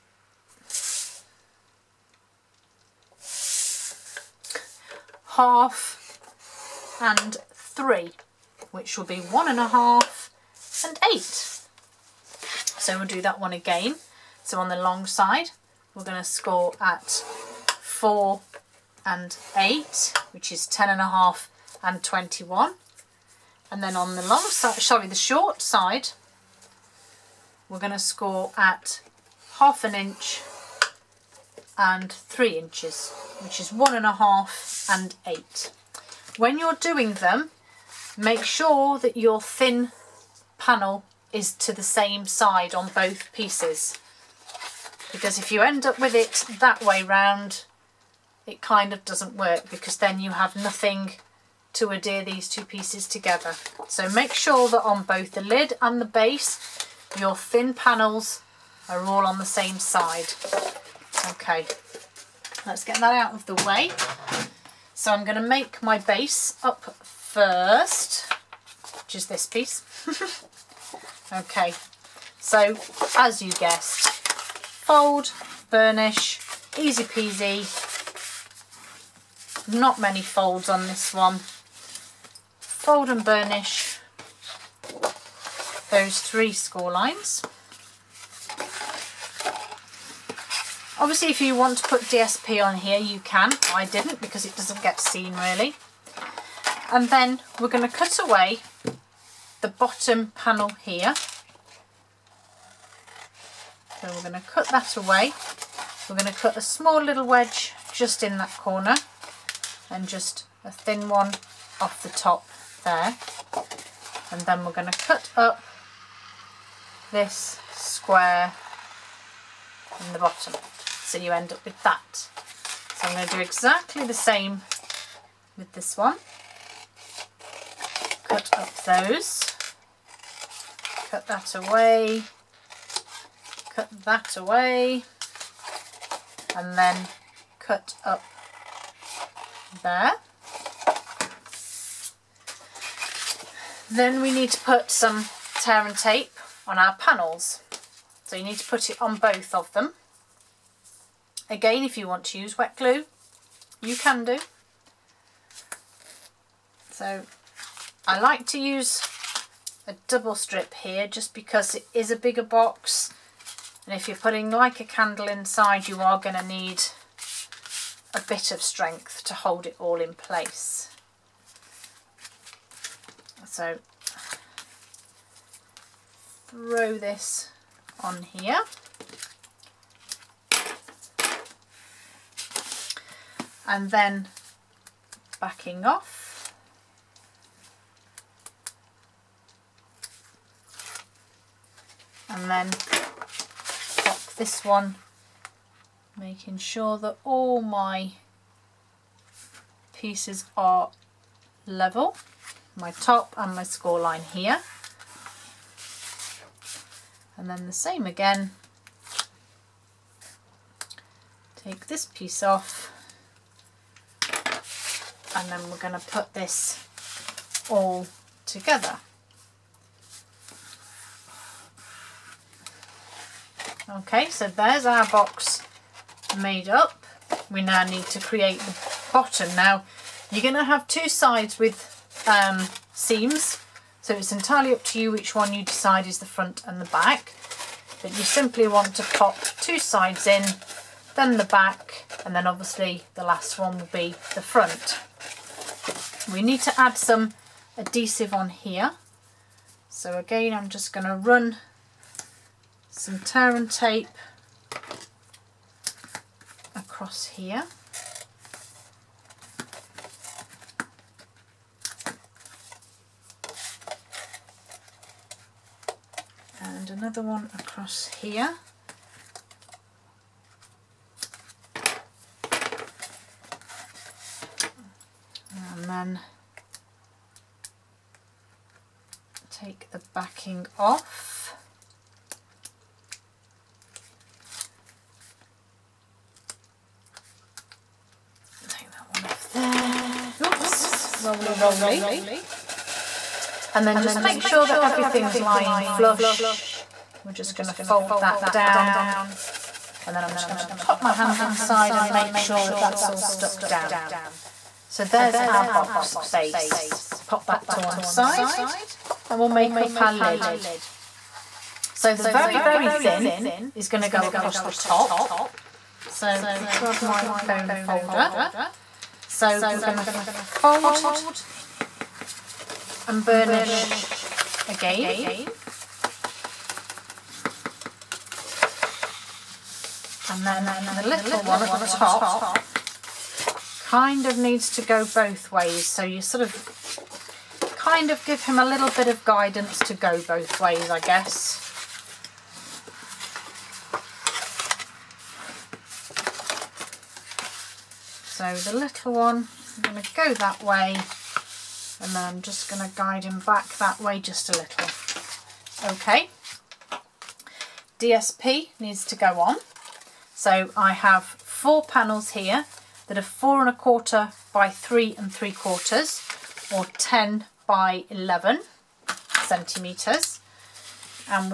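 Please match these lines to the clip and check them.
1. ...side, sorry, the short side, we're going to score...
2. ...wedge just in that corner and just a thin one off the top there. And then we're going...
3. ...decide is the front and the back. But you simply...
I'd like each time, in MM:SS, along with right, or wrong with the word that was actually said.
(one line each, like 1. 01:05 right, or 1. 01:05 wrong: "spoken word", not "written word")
1. 00:24 right
2. 01:47 right
3. 03:55 right.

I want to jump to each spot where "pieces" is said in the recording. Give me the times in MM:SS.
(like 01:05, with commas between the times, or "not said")
00:43, 00:52, 01:09, 03:19, 03:32.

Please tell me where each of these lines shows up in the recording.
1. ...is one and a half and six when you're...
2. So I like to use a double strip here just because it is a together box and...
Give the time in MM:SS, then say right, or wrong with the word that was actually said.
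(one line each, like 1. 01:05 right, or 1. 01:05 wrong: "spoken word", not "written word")
1. 00:33 wrong: "eight", not "six"
2. 02:36 wrong: "bigger", not "together".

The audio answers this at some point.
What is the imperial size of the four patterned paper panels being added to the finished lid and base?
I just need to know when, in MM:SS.
06:03.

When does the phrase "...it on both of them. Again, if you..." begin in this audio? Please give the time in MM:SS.
02:28.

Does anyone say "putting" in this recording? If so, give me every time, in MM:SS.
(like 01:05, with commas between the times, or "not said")
02:44.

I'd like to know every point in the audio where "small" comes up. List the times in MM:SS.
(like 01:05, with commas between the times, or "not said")
01:46.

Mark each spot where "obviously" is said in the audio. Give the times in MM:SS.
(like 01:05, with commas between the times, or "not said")
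01:30, 04:02.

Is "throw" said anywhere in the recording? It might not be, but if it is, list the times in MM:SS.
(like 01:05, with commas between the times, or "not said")
02:56.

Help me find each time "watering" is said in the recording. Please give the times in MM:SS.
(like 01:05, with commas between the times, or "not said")
not said.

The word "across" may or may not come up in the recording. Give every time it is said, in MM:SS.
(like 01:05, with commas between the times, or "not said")
04:16, 04:27, 05:14.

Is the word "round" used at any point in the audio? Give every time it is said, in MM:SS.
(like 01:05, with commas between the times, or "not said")
00:47.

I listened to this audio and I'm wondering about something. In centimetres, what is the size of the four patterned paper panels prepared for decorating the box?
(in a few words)
10 by 11 centimetres.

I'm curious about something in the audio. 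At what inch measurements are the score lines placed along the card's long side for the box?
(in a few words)
4 and 8.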